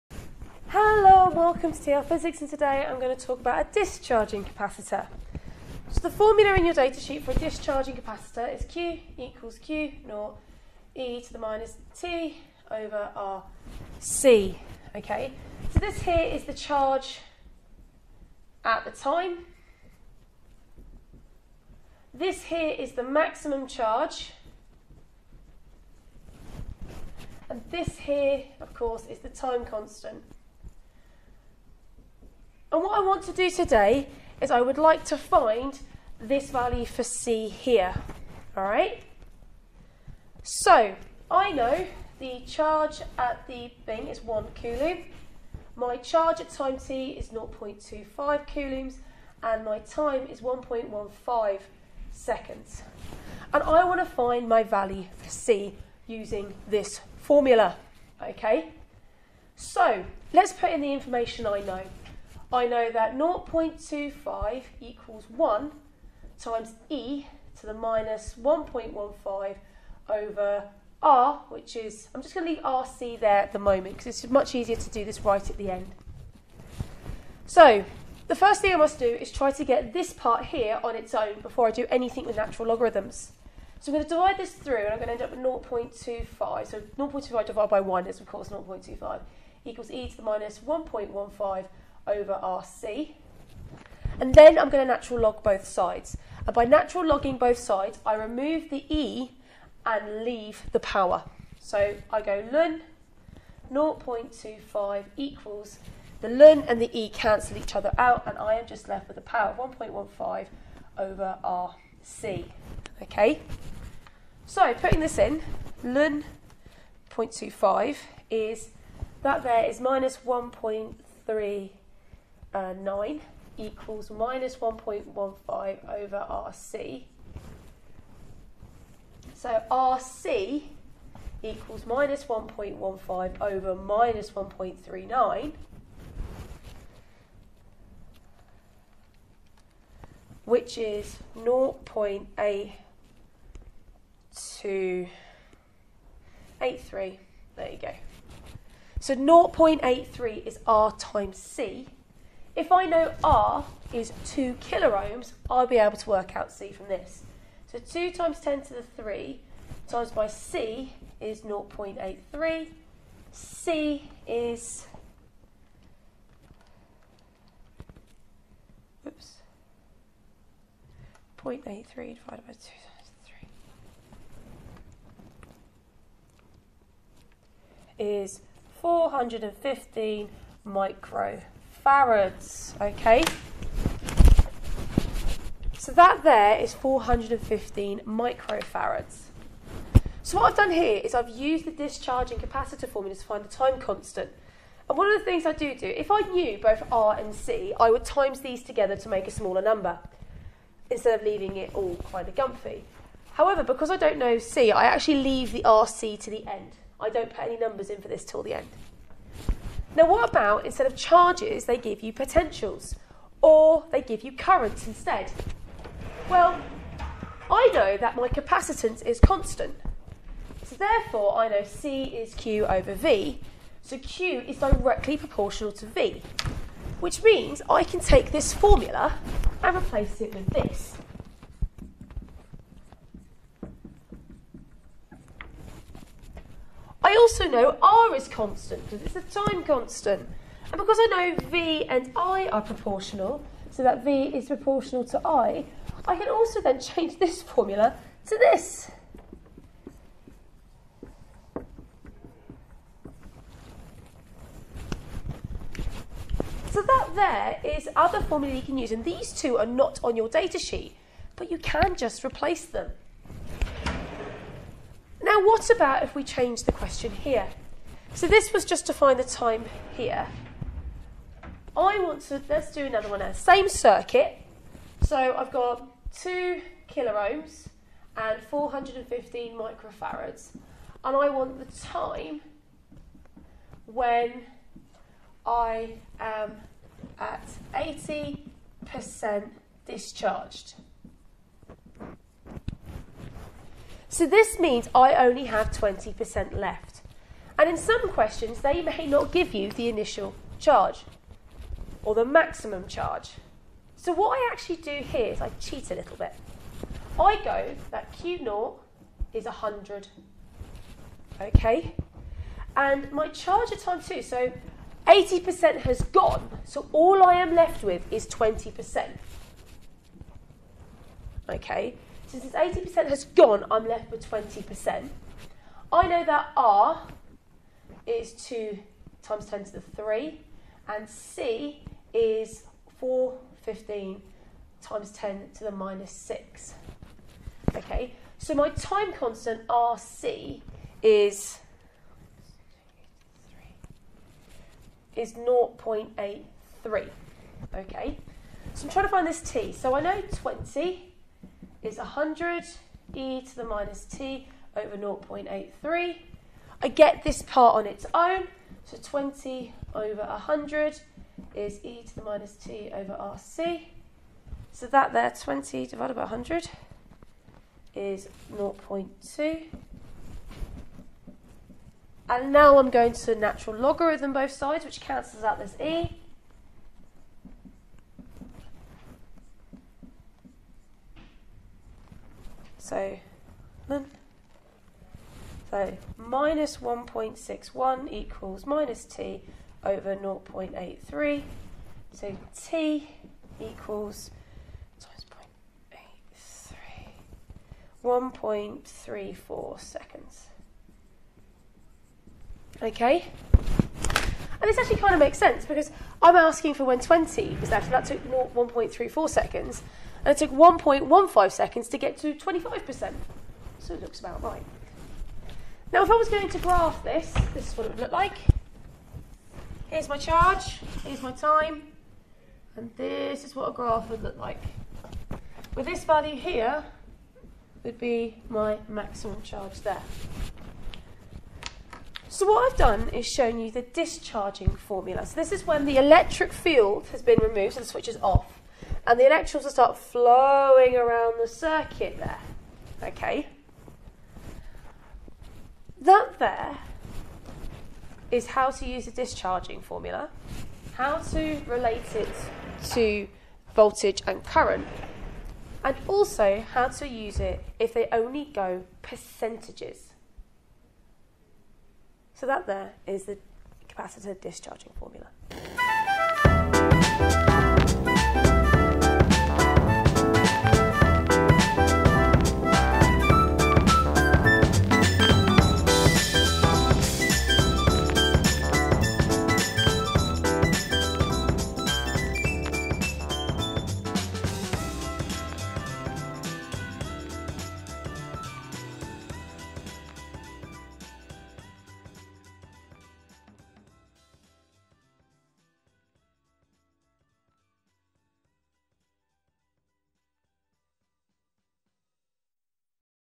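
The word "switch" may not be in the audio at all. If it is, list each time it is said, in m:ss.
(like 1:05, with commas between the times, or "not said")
7:17.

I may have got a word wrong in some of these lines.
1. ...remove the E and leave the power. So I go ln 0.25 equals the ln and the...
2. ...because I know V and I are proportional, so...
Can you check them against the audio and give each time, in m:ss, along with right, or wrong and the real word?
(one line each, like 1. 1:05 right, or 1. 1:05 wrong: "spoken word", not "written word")
1. 1:38 right
2. 4:00 right.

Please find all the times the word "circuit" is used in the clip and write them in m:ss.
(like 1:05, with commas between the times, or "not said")
4:33, 7:21.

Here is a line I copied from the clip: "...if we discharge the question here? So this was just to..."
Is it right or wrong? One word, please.
wrong.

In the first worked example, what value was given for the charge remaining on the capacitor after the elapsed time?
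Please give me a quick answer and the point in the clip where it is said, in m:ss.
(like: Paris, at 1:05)
0.25 coulombs, at 0:47.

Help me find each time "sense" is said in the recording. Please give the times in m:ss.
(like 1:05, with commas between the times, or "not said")
6:45.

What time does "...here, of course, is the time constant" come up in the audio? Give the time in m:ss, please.
0:27.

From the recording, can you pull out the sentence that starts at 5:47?
Okay, so I'm trying to find this T.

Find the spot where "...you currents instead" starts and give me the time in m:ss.
3:34.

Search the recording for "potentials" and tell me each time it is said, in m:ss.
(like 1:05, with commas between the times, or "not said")
3:32.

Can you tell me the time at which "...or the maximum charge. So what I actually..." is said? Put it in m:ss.
5:02.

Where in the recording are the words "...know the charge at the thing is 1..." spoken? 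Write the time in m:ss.
0:41.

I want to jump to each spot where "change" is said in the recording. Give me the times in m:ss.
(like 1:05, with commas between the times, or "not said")
4:06, 4:26.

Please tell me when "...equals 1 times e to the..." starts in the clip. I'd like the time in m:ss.
1:04.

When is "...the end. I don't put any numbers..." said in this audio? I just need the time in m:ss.
3:26.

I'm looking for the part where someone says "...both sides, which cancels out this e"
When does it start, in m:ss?
6:14.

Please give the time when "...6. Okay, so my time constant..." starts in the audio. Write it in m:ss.
5:36.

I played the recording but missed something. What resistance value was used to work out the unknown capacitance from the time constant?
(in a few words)
2 kiloohms.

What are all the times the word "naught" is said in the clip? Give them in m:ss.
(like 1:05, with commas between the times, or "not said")
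0:10, 5:08.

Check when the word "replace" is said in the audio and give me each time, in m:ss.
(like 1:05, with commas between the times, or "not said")
3:49, 4:22.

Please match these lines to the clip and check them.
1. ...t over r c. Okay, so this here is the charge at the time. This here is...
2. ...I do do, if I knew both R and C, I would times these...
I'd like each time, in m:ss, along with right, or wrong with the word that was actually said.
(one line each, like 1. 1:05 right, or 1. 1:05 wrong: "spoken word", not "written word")
1. 0:11 right
2. 3:15 right.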